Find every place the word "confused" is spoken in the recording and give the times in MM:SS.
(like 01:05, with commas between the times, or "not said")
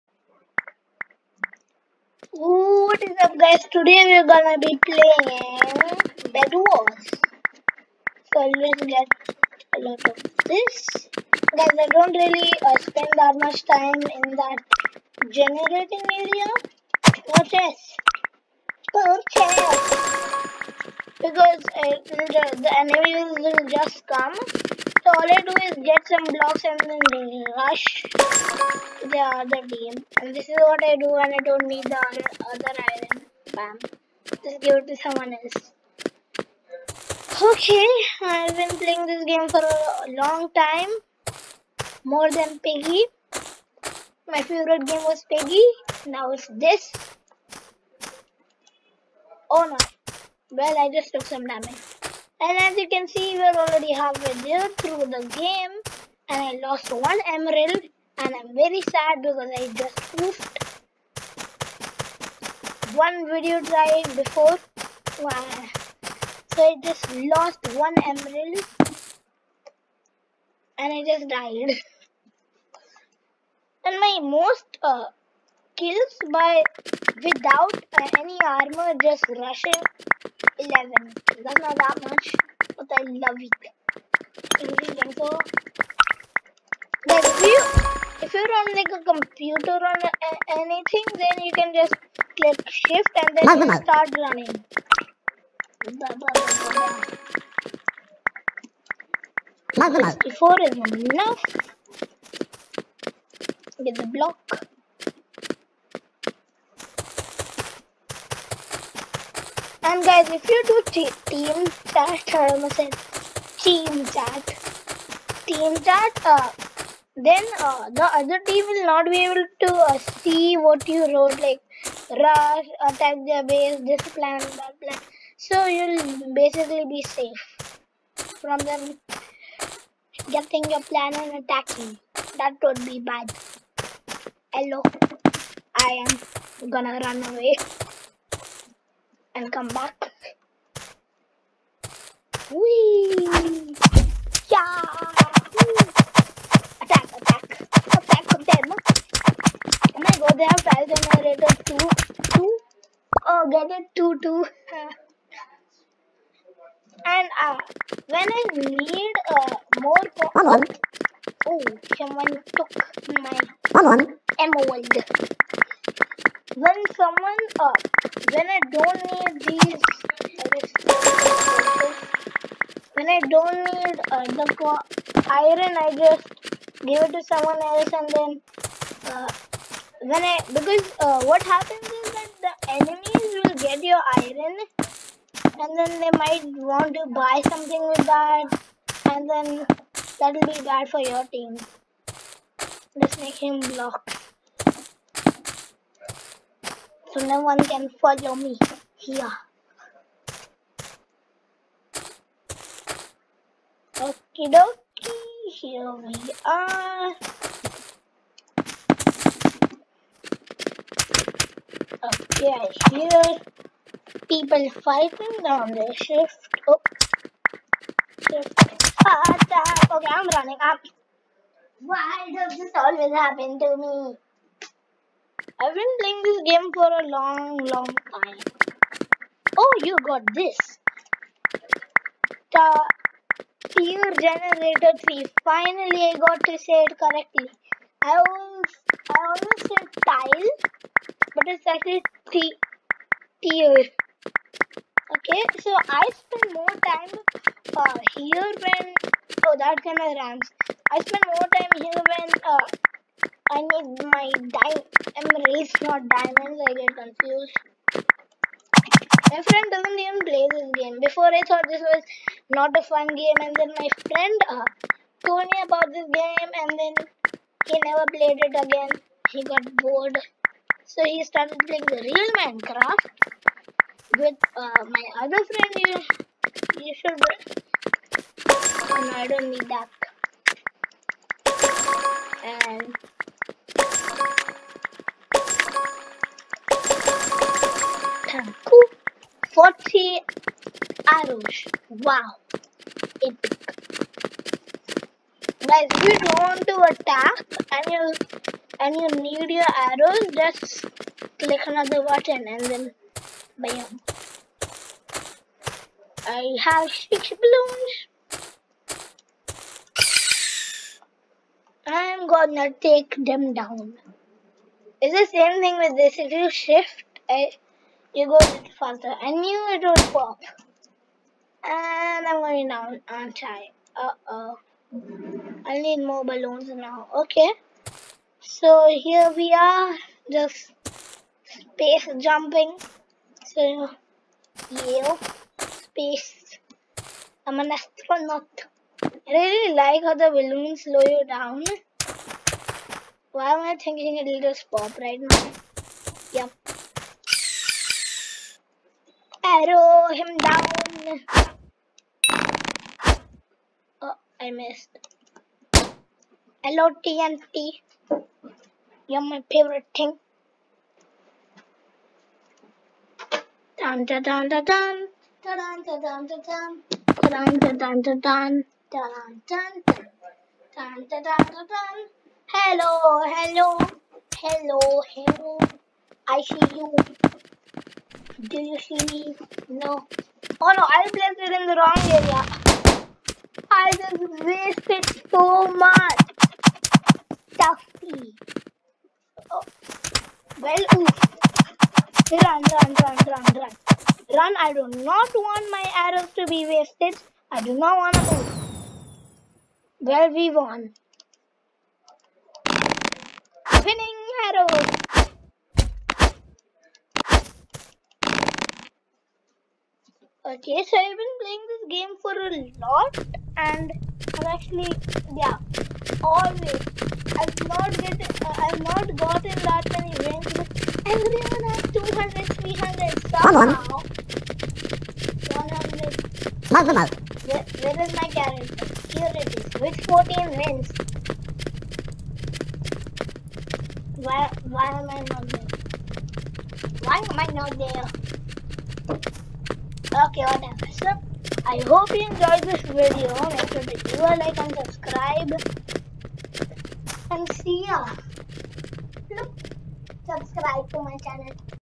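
04:16.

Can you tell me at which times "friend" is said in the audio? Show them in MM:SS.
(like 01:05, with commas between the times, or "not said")
04:19, 04:24, 04:35.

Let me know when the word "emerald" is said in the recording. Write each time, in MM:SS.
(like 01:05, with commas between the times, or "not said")
00:57, 01:08, 02:44.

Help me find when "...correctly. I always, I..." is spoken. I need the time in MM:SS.
03:56.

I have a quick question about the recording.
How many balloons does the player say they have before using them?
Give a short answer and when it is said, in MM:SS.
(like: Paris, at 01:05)
6, at 05:06.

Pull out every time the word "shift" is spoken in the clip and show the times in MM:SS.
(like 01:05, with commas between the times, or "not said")
01:32, 03:35, 05:16.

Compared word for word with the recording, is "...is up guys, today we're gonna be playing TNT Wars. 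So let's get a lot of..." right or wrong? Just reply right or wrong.
wrong.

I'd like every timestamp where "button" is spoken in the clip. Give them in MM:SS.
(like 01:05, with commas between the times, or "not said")
05:02.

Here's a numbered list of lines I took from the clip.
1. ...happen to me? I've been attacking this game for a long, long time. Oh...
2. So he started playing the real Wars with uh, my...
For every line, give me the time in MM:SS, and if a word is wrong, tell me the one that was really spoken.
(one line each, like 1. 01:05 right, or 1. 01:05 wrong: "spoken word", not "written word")
1. 03:43 wrong: "playing", not "attacking"
2. 04:30 wrong: "Minecraft", not "Wars".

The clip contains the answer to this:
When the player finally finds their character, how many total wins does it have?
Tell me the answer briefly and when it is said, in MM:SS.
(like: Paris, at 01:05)
14, at 07:10.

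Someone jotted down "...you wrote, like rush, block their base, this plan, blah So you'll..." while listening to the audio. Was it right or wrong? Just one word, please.
wrong.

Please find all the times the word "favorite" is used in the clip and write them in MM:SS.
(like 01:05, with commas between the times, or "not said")
00:44, 05:59.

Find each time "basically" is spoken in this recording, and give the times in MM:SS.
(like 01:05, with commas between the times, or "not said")
02:06.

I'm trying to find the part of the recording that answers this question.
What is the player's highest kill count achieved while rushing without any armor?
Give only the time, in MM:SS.
01:20.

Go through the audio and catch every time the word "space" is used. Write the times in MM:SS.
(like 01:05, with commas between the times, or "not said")
05:31, 05:35.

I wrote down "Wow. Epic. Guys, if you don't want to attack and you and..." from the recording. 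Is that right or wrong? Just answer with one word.
right.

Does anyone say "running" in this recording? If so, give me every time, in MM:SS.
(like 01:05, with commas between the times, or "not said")
01:34, 03:40.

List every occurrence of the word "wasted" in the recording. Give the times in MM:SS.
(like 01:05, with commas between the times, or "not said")
06:24, 06:36.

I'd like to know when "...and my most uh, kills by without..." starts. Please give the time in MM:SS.
01:13.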